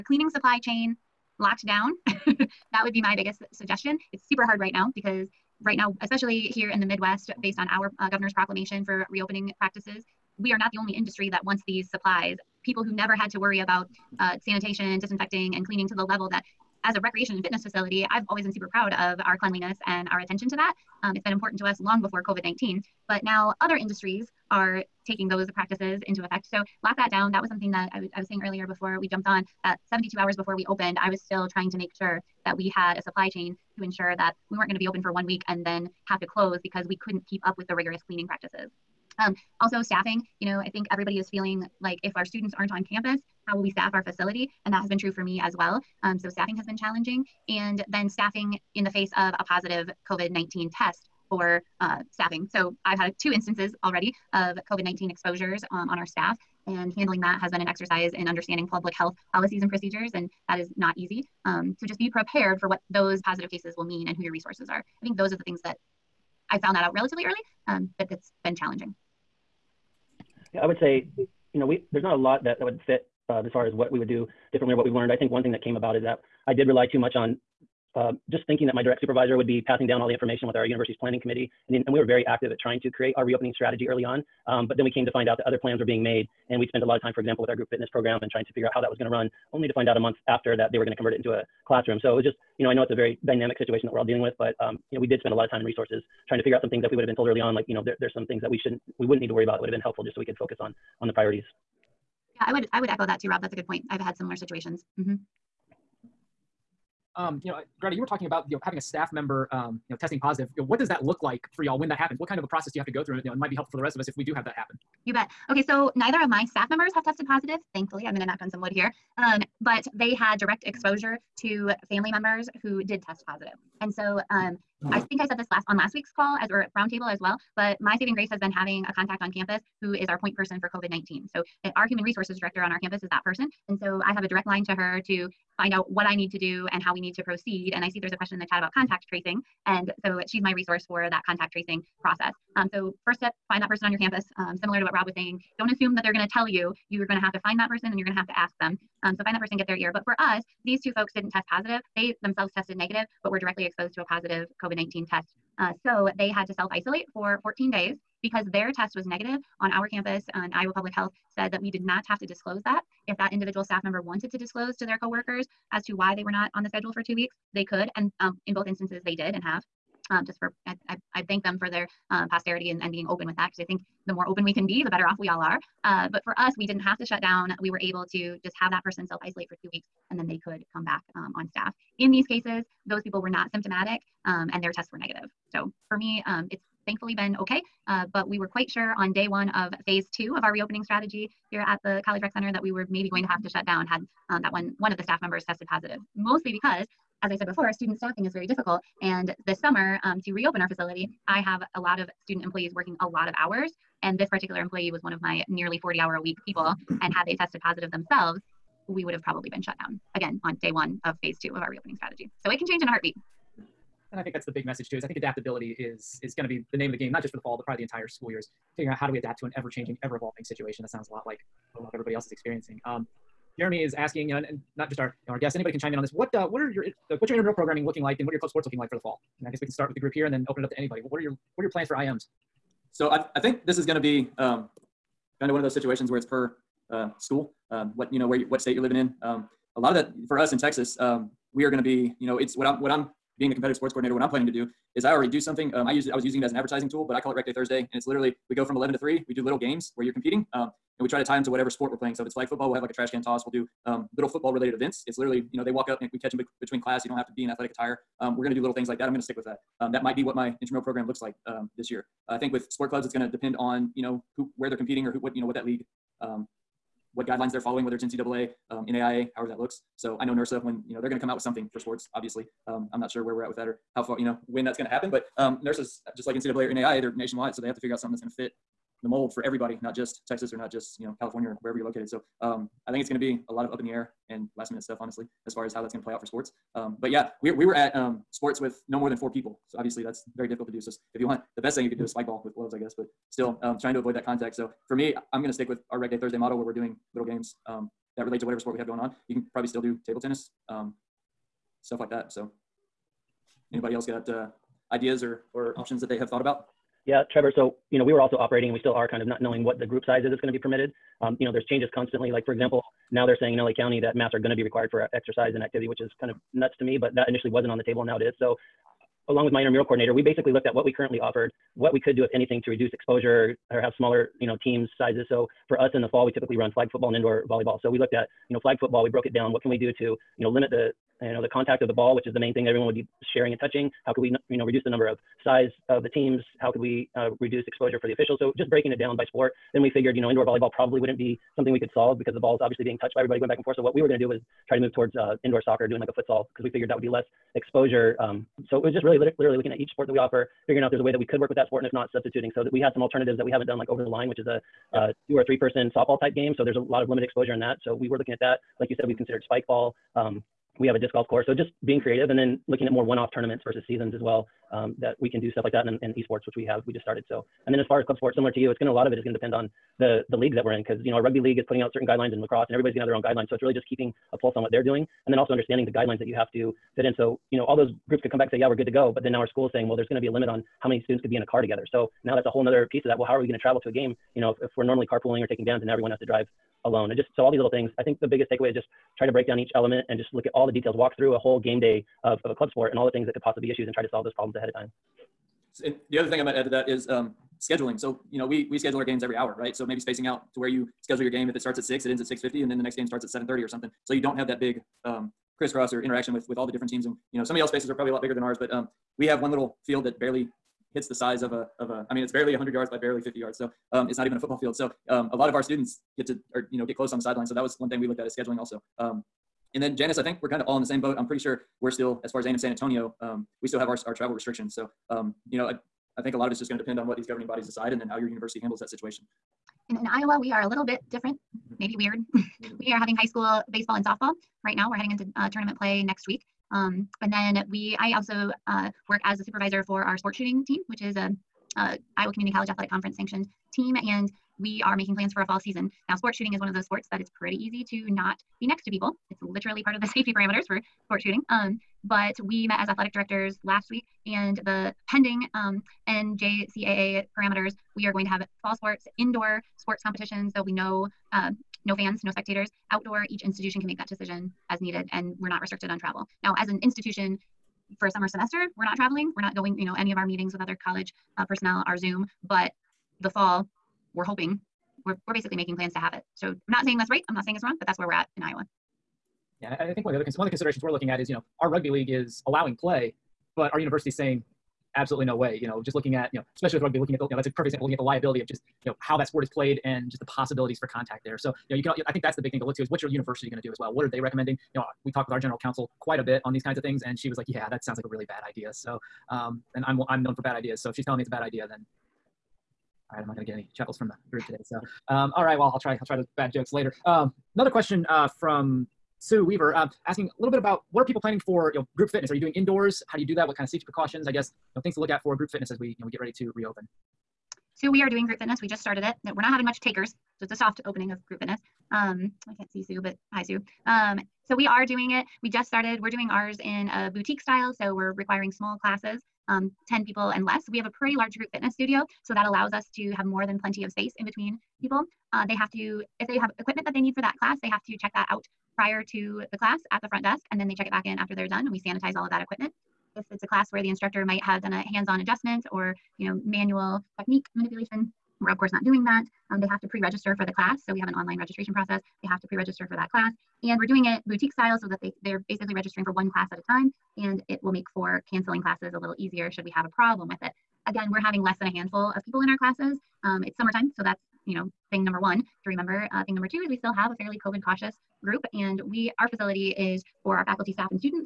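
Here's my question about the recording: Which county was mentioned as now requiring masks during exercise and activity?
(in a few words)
LA County.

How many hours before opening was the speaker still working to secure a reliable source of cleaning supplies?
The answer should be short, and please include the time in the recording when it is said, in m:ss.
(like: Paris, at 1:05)
72, at 0:29.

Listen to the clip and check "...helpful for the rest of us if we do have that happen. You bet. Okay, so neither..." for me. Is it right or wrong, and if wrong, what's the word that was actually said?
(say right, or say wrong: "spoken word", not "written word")
right.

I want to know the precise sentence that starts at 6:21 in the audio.
So now that's a whole nother piece of that.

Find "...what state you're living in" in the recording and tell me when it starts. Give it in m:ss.
3:58.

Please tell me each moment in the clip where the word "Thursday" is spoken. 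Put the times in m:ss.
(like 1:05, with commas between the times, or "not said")
4:07, 4:56.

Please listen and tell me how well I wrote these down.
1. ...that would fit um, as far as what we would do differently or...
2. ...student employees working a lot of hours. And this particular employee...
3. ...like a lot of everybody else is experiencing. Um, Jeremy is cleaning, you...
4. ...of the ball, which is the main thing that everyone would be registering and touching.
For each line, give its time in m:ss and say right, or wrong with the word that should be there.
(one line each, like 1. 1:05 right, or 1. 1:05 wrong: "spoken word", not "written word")
1. 1:12 right
2. 3:22 right
3. 3:41 wrong: "asking", not "cleaning"
4. 5:31 wrong: "sharing", not "registering".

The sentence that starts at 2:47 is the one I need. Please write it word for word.
And um, in both instances, they did and have.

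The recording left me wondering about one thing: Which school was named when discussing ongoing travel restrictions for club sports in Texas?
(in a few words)
A&M San Antonio.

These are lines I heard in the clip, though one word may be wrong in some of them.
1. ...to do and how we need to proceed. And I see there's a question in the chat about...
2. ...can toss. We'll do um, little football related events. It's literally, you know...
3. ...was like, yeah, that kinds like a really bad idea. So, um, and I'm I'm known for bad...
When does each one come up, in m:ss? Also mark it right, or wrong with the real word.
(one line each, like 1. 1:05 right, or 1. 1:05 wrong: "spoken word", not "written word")
1. 2:16 right
2. 4:13 right
3. 8:17 wrong: "sounds", not "kinds".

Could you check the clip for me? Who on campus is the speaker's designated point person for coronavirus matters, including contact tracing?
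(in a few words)
Human resources director.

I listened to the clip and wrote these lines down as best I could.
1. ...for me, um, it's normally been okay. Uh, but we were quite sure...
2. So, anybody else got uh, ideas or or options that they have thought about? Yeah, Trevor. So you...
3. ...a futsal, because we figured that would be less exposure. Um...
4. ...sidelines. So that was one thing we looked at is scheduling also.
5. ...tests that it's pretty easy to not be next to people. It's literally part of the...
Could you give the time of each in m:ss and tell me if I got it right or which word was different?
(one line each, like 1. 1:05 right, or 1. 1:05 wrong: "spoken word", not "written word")
1. 3:05 wrong: "thankfully", not "normally"
2. 5:02 right
3. 5:46 right
4. 6:57 right
5. 7:26 wrong: "sports", not "tests".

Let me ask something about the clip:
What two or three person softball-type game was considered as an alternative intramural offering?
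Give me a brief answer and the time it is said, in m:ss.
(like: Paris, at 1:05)
Over the line, at 5:53.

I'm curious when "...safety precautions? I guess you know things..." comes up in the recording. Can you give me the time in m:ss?
8:33.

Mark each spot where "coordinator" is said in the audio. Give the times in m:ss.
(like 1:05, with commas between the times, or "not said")
4:03, 5:19.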